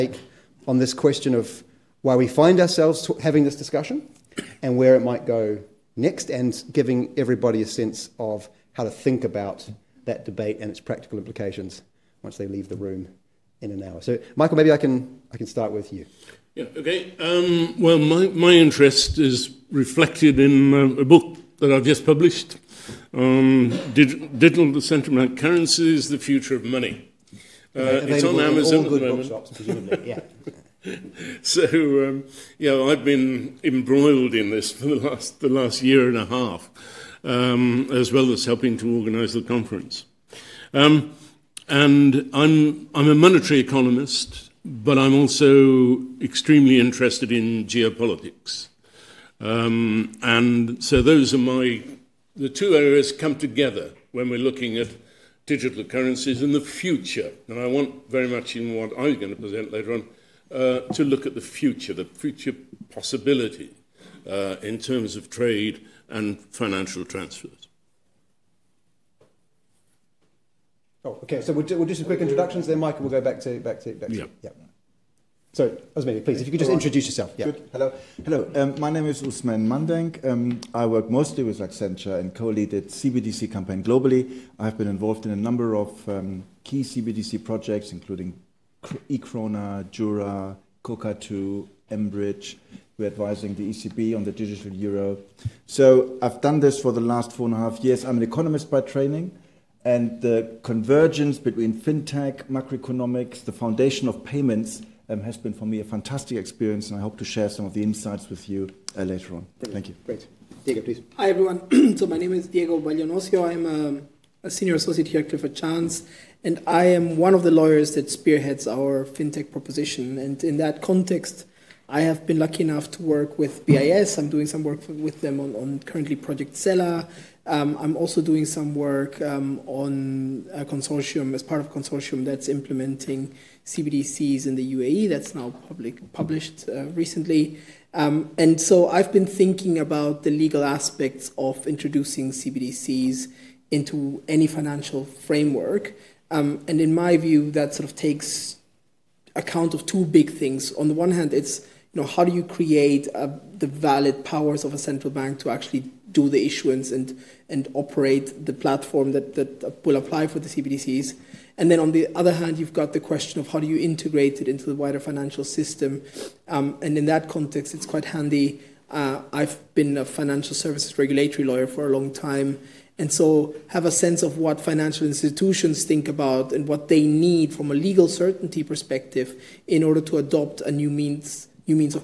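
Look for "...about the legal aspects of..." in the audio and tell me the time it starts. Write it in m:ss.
2:19.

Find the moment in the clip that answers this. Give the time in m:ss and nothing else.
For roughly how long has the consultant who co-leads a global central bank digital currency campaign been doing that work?
1:37.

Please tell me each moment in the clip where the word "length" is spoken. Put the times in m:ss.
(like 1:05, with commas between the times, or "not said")
not said.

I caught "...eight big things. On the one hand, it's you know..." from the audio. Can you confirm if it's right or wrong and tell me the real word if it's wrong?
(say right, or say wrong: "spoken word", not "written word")
wrong: "two", not "eight".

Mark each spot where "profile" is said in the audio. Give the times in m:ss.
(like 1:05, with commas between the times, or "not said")
not said.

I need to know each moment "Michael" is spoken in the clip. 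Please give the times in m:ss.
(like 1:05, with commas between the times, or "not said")
0:14, 1:12.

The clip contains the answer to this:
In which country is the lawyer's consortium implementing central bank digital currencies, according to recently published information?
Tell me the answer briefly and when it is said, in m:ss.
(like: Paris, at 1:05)
UAE, at 2:14.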